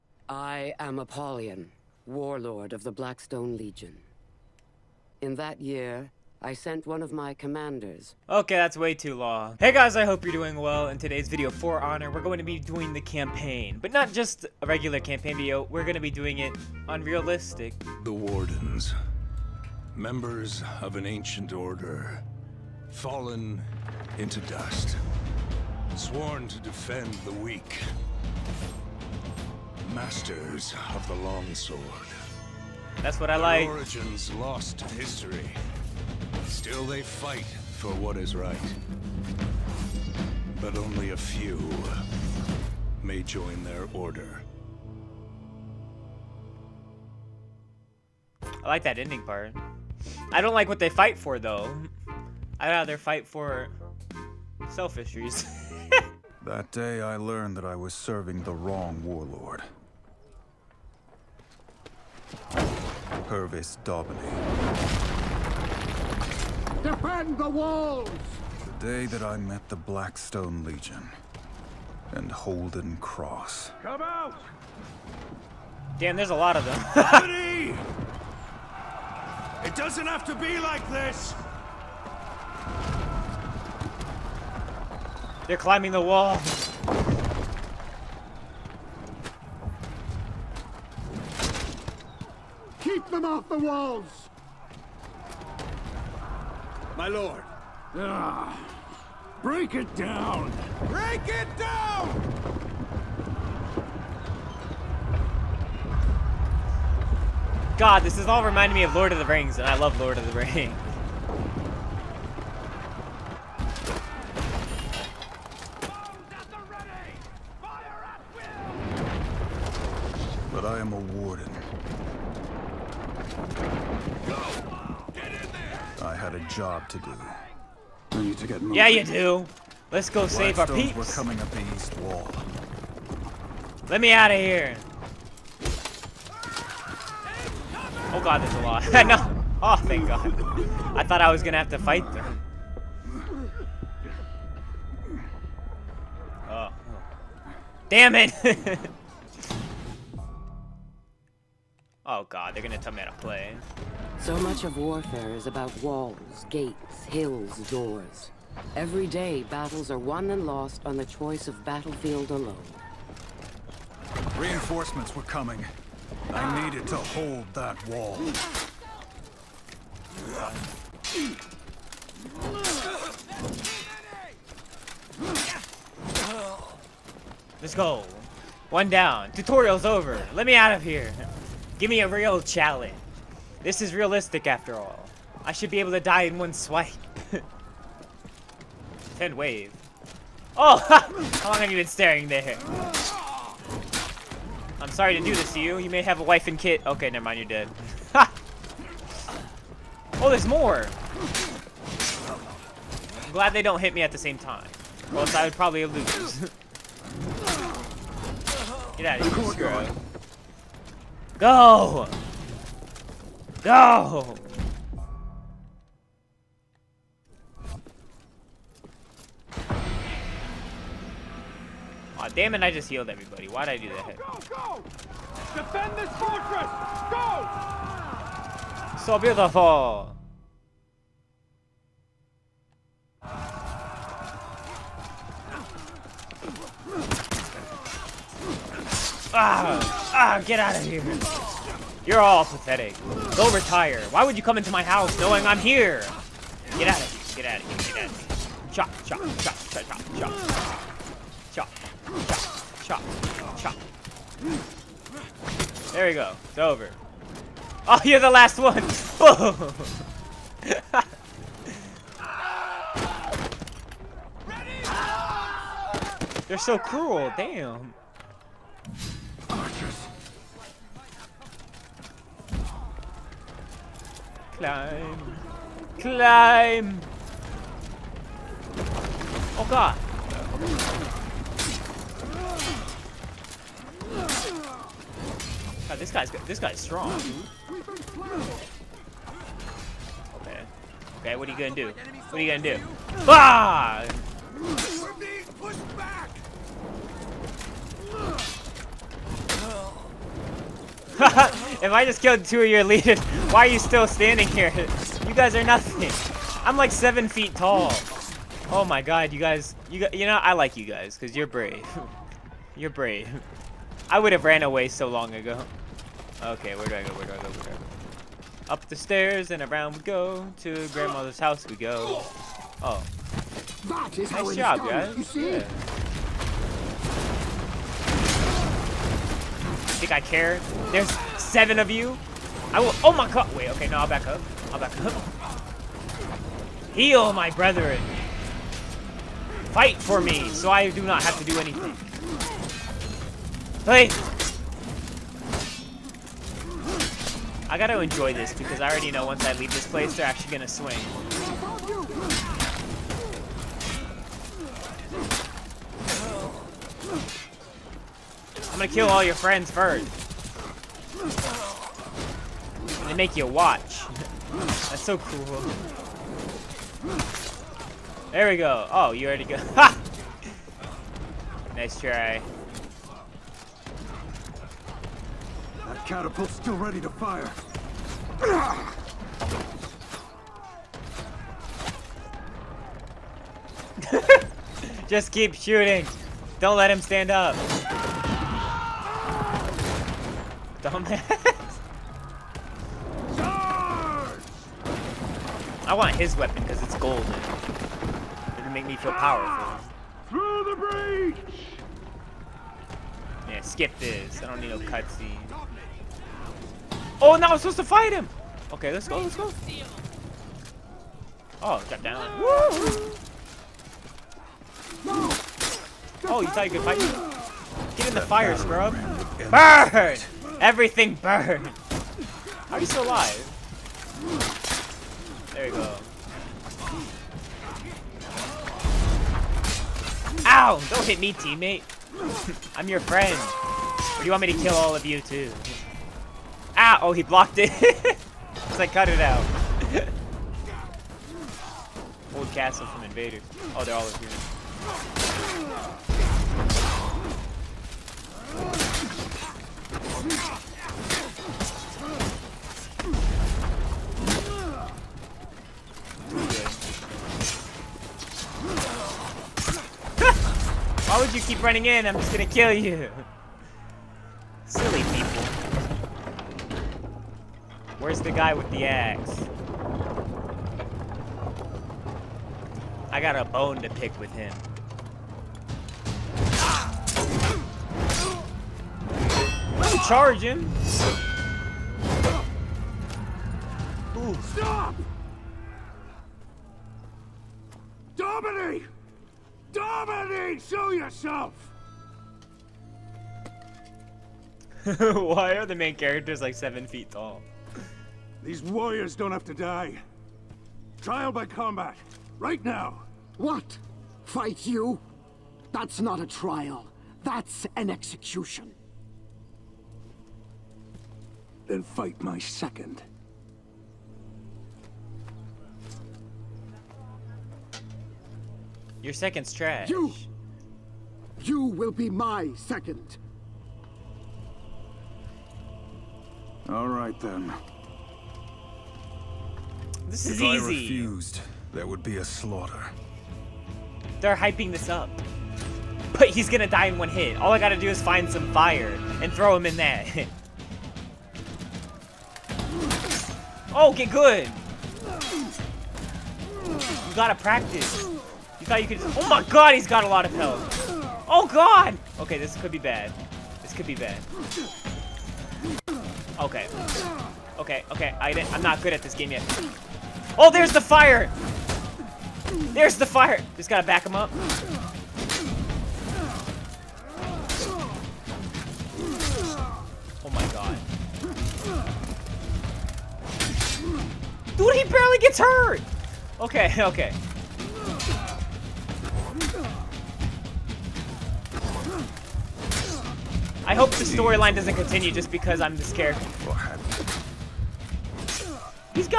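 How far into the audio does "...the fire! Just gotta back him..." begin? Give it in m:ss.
9:22.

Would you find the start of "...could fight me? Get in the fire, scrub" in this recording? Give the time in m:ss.
6:56.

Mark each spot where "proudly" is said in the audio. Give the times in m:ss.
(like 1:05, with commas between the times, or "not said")
not said.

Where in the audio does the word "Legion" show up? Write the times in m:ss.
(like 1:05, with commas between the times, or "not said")
0:03, 1:10.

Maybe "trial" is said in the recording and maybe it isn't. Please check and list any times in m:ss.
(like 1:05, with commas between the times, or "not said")
8:21, 8:26.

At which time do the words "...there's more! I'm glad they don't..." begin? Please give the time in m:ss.
3:20.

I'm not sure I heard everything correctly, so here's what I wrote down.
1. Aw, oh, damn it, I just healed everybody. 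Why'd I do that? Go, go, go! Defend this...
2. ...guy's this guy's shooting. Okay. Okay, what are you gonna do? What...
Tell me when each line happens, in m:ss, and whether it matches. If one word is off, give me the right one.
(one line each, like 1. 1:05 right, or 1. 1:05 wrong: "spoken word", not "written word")
1. 3:33 right
2. 4:46 wrong: "strong", not "shooting".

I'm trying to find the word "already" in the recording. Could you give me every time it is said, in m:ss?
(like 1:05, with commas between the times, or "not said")
5:48, 6:09.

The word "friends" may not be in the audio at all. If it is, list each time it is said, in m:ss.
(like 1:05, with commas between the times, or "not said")
5:59, 7:13.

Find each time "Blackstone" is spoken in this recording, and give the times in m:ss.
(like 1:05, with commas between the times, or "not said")
0:02, 1:09.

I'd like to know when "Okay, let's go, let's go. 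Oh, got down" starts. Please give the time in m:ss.
6:48.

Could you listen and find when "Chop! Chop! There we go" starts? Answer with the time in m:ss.
4:13.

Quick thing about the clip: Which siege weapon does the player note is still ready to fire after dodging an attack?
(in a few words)
Catapult.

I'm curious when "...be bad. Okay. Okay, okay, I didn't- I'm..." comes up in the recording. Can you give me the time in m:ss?
9:13.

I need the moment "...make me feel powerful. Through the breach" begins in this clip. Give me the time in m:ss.
6:38.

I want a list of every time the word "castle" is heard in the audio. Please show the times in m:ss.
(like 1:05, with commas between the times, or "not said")
7:22.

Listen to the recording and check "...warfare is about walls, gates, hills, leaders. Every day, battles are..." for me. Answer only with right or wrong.
wrong.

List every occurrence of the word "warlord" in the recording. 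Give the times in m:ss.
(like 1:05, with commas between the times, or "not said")
0:02, 0:59.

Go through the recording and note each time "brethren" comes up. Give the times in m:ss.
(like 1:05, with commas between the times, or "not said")
5:37.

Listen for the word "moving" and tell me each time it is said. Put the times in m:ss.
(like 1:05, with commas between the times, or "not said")
2:08.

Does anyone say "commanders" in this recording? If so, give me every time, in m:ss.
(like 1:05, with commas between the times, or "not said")
0:07.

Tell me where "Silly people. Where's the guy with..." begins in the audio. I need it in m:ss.
7:44.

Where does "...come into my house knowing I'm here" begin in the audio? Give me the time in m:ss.
4:04.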